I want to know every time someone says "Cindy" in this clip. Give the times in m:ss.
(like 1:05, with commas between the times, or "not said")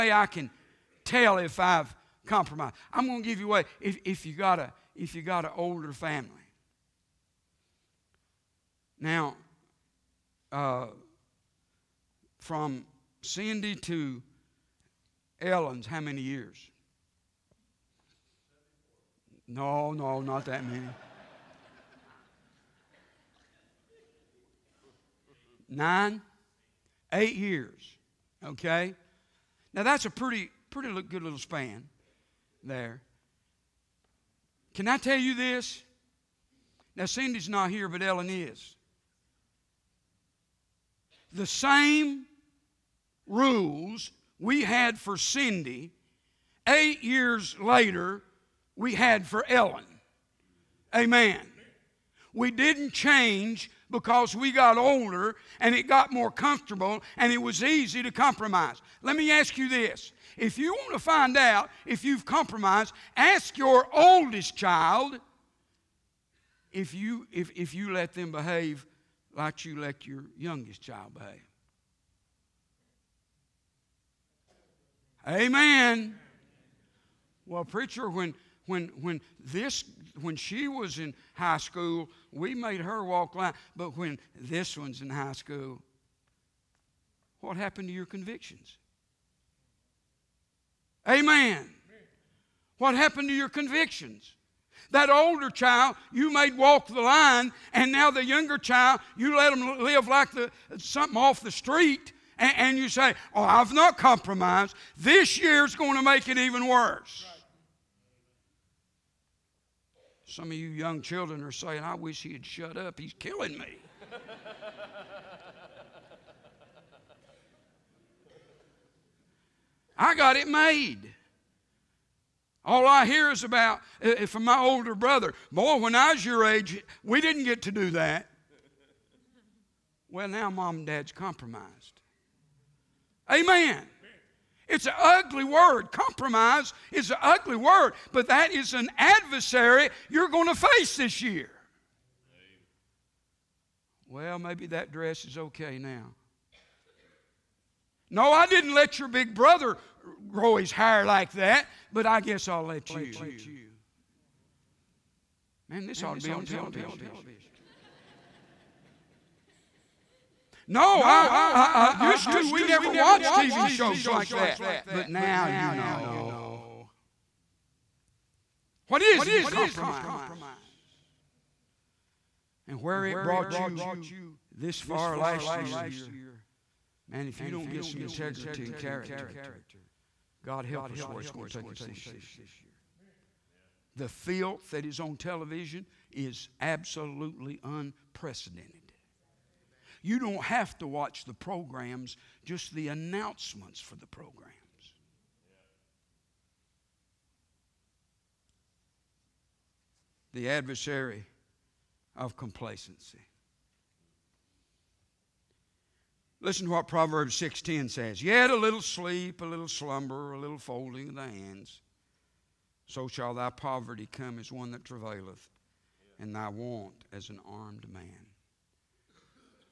0:13, 0:37, 0:45.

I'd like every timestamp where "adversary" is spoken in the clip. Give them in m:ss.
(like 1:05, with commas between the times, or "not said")
2:18, 3:20.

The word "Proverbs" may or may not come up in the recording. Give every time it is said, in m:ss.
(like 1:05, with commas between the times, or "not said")
3:26.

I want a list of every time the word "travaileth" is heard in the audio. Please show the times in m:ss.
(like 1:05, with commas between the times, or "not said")
3:34.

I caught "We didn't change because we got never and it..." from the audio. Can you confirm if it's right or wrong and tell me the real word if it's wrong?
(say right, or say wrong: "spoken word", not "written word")
wrong: "older", not "never".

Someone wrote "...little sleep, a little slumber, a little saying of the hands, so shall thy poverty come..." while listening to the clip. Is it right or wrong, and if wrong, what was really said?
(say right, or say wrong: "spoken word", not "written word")
wrong: "folding", not "saying".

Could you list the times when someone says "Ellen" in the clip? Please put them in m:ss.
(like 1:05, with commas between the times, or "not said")
0:15, 0:38, 0:49.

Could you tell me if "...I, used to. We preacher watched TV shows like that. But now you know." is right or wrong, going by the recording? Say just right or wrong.
wrong.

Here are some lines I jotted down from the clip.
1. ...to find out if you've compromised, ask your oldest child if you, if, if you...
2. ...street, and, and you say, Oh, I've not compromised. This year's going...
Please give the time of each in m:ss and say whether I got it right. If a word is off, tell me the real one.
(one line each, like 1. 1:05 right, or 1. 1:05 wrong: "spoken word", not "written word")
1. 1:00 right
2. 1:41 right.